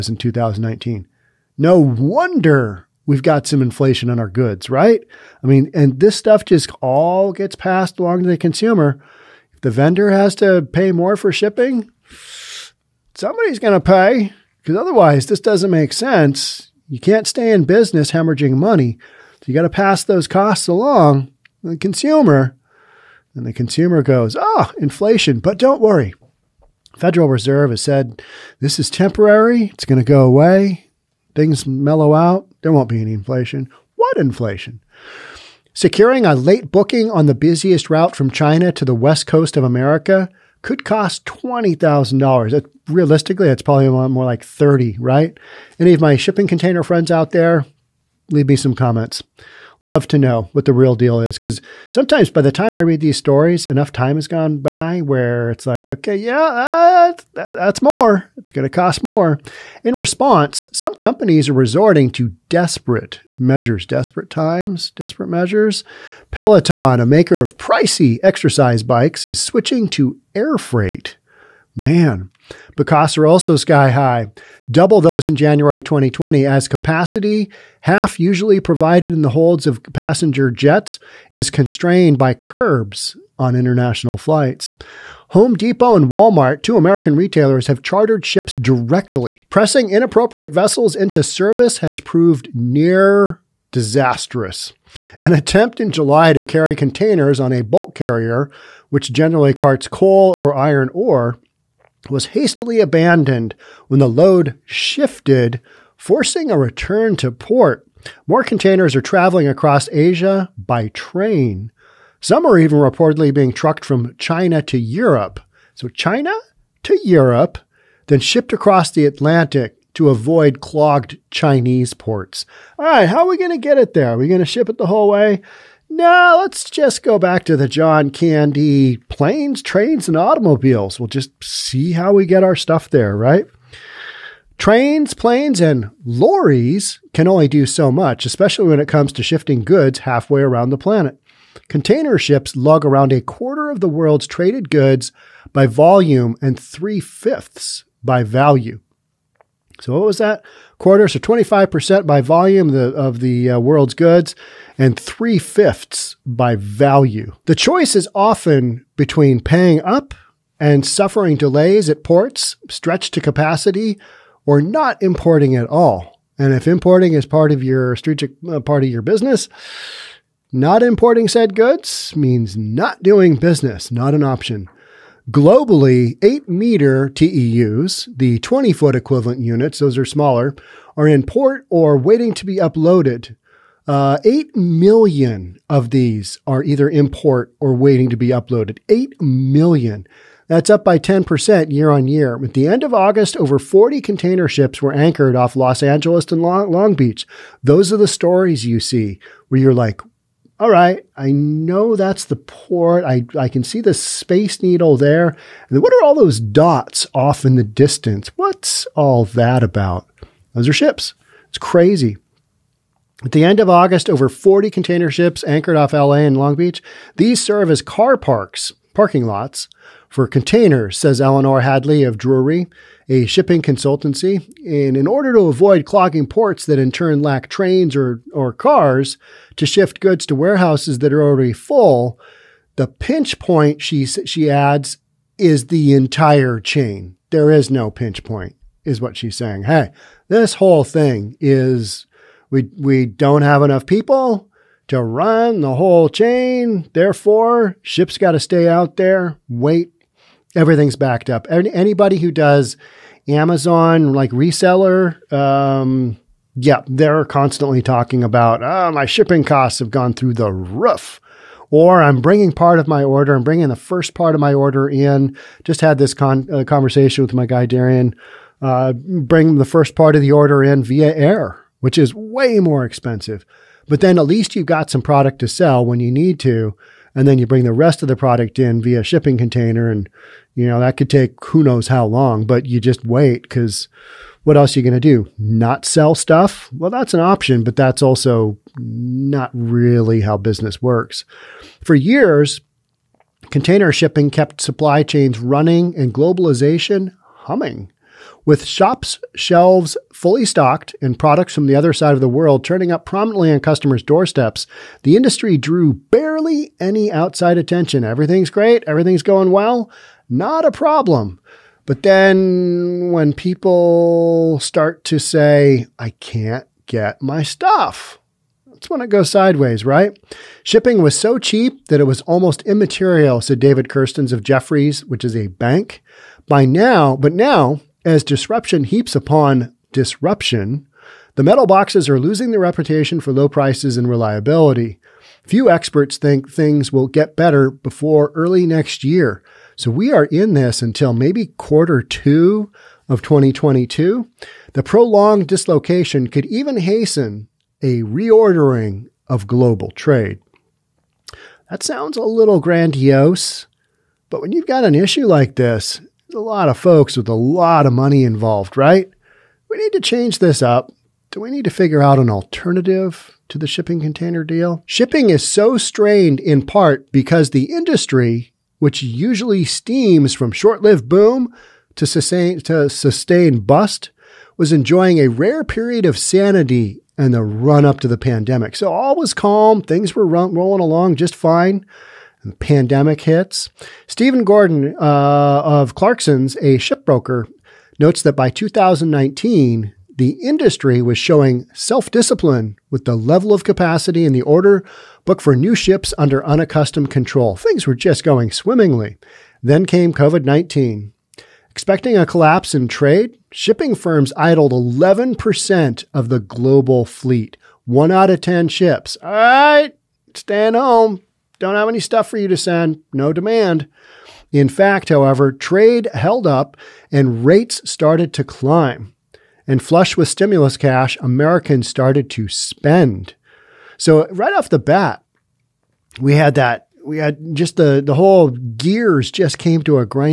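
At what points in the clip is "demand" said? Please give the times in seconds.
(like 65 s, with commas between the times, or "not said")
413 s.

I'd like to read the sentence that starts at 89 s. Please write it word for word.
Pressing inappropriate vessels into service has proved near disastrous.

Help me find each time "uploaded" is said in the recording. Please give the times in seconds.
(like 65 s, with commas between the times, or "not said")
182 s, 188 s.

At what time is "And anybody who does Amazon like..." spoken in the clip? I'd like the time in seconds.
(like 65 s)
251 s.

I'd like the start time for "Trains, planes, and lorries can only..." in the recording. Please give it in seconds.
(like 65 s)
134 s.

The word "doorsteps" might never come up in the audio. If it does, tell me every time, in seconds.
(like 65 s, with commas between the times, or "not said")
304 s.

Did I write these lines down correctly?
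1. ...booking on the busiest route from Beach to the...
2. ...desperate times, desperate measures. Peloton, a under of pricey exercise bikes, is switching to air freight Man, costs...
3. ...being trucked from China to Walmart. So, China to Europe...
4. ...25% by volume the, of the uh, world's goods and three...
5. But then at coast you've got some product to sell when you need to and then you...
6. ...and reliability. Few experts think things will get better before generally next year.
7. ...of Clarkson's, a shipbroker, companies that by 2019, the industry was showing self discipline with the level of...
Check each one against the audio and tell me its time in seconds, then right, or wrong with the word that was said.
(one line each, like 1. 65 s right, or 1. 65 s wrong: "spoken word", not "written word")
1. 36 s wrong: "China", not "Beach"
2. 63 s wrong: "maker", not "under"
3. 113 s wrong: "Europe", not "Walmart"
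4. 151 s right
5. 273 s wrong: "least", not "coast"
6. 333 s wrong: "early", not "generally"
7. 385 s wrong: "notes", not "companies".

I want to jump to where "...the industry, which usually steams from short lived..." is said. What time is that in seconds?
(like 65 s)
367 s.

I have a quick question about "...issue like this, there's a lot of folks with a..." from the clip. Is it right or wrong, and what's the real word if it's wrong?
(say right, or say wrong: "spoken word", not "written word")
right.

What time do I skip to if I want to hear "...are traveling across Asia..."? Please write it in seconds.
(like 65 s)
108 s.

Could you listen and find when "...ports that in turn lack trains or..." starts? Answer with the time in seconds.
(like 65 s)
226 s.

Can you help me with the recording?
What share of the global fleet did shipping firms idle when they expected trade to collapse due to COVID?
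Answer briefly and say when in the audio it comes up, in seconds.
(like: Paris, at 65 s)
11%, at 404 s.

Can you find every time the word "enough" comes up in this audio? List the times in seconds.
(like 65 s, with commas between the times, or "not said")
53 s, 243 s.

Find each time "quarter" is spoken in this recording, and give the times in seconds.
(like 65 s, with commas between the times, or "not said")
143 s, 150 s, 341 s.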